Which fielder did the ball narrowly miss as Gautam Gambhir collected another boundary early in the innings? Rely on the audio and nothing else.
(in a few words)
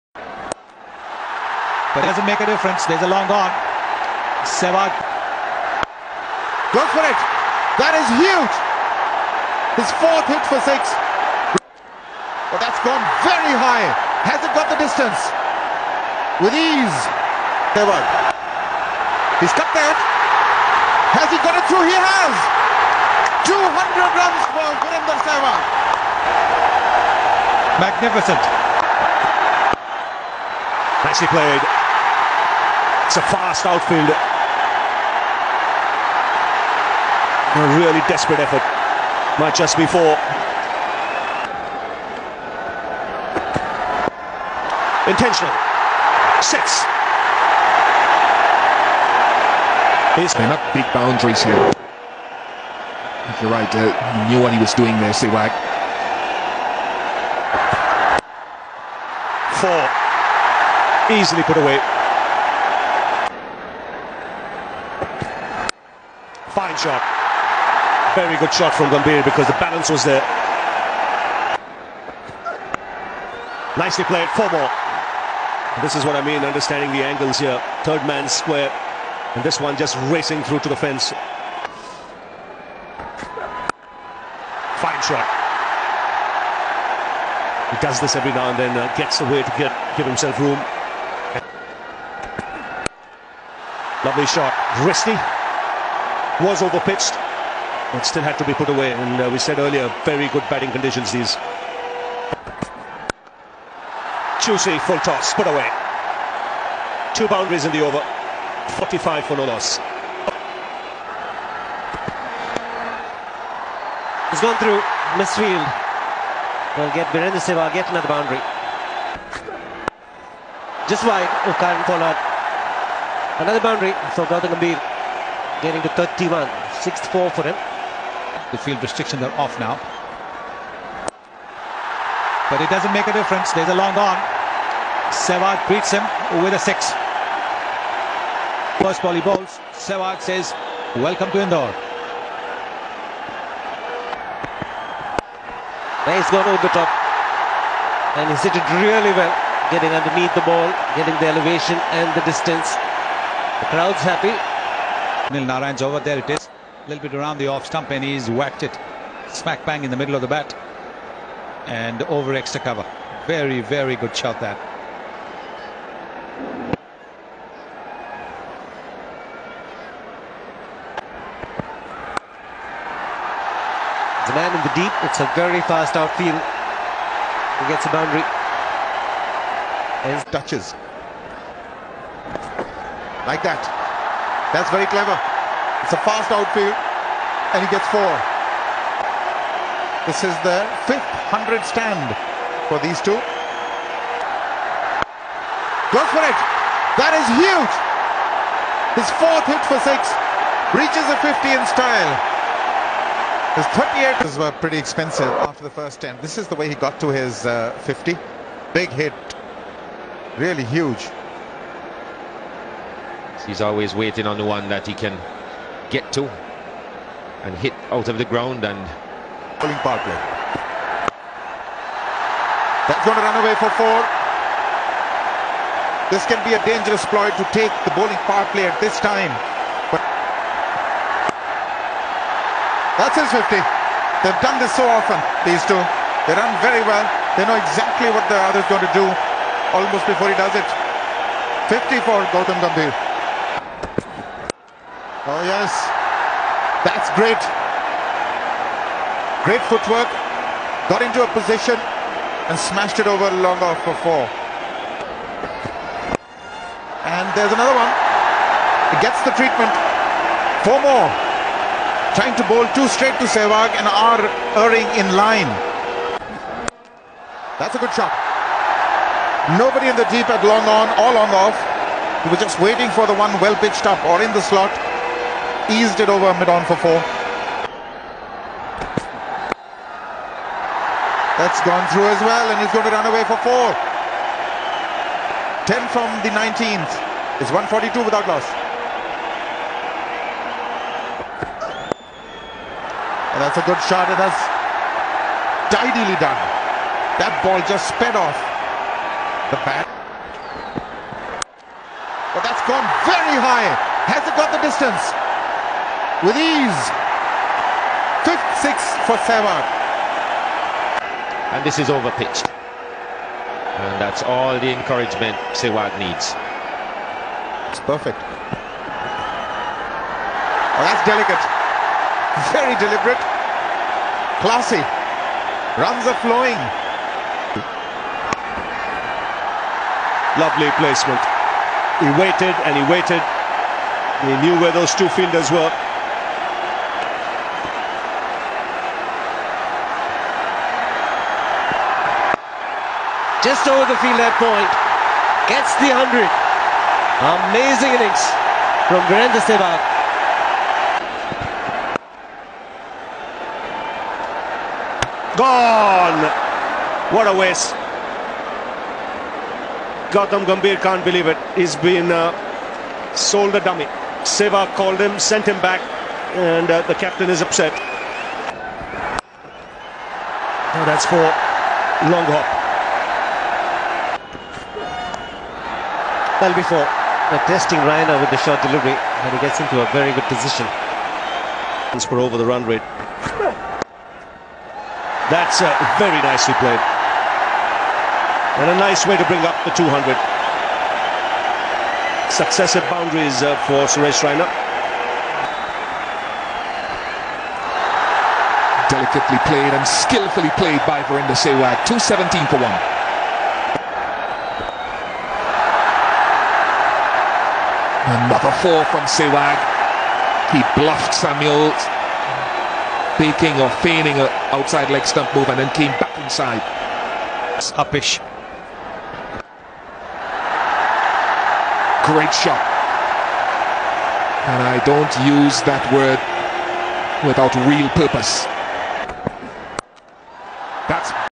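Kieron Pollard.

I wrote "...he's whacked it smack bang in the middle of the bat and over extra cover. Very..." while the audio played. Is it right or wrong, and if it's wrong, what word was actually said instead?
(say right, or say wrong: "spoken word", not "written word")
right.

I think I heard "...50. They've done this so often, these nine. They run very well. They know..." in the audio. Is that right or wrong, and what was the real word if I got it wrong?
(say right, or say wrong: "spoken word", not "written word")
wrong: "two", not "nine".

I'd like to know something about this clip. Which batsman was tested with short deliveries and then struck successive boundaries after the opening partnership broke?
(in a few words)
Suresh Raina.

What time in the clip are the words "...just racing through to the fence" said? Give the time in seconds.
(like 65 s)
79 s.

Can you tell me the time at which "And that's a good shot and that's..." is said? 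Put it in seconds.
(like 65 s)
293 s.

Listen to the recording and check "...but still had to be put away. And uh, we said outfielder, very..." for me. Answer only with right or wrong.
wrong.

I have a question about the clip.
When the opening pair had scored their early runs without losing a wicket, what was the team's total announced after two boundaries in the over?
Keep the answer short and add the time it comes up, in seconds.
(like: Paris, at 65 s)
45, at 108 s.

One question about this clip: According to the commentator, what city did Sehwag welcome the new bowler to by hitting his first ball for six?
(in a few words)
Indore.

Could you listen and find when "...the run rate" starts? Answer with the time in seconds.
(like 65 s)
382 s.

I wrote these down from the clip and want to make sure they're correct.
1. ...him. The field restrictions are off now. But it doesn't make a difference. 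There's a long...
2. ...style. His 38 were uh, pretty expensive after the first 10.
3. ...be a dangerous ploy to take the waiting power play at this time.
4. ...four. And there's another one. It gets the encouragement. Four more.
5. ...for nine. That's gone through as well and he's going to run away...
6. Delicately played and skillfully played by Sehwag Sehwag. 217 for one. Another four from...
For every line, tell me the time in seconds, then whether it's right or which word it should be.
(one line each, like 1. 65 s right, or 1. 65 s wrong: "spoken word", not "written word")
1. 127 s right
2. 201 s right
3. 226 s wrong: "bowling", not "waiting"
4. 254 s wrong: "treatment", not "encouragement"
5. 276 s wrong: "four", not "nine"
6. 398 s wrong: "Virender", not "Sehwag".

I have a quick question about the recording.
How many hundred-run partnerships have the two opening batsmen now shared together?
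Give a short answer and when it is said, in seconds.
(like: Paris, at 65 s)
5, at 190 s.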